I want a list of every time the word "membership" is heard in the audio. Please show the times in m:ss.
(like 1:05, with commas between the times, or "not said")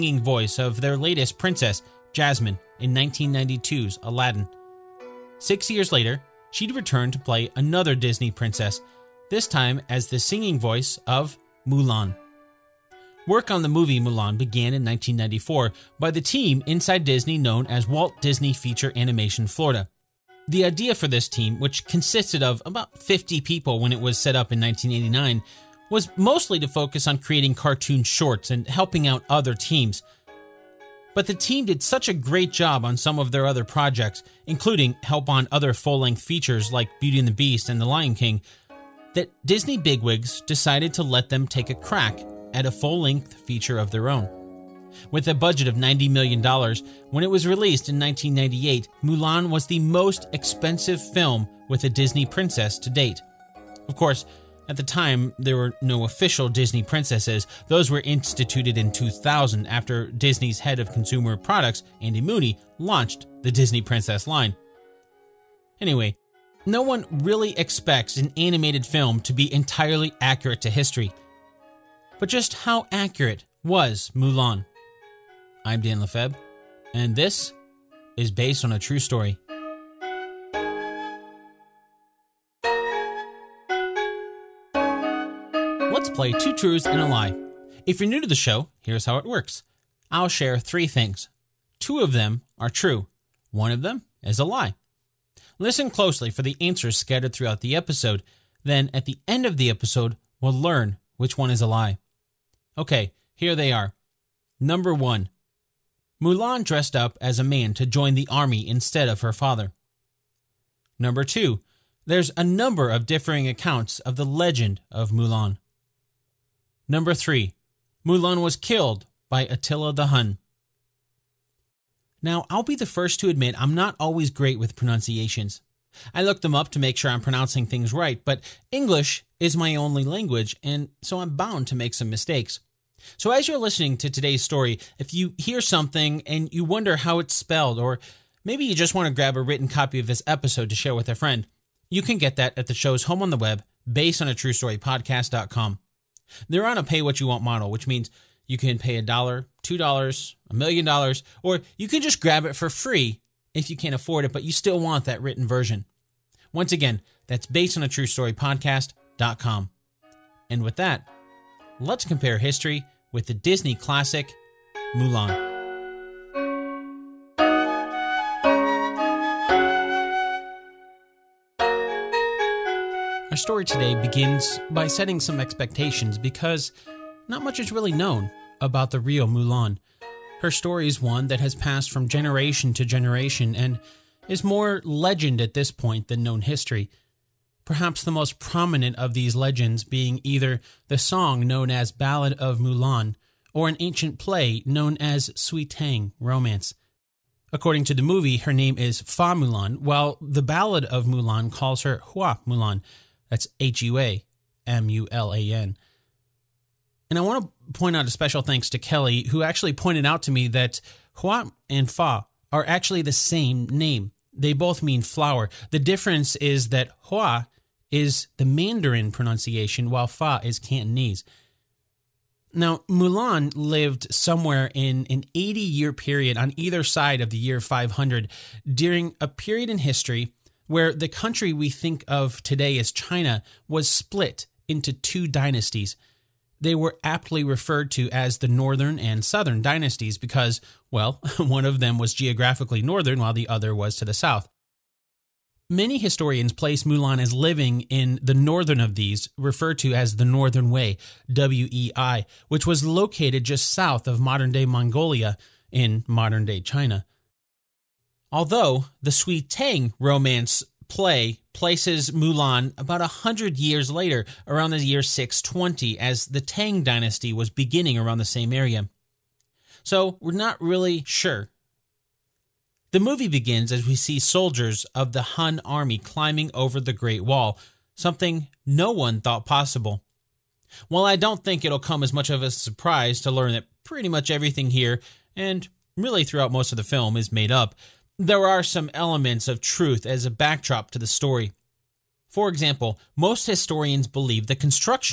not said.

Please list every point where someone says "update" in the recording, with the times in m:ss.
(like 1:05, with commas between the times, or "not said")
not said.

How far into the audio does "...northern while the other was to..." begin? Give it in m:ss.
4:02.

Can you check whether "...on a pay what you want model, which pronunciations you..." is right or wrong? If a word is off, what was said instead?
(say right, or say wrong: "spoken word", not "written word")
wrong: "means", not "pronunciations".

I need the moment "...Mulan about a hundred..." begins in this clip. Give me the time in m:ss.
4:22.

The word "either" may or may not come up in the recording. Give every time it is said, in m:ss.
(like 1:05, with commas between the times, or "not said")
3:10, 3:46.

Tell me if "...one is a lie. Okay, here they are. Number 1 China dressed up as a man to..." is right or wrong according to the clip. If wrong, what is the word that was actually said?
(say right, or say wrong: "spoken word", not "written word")
wrong: "Mulan", not "China".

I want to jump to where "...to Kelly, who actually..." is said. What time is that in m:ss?
3:28.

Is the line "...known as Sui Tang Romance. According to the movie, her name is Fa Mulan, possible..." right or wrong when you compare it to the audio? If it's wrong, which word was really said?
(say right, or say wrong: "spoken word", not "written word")
wrong: "while", not "possible".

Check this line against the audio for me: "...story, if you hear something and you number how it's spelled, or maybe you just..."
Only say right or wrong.
wrong.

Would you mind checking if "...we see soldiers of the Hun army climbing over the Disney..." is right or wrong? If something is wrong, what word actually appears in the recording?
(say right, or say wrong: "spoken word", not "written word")
wrong: "Great", not "Disney".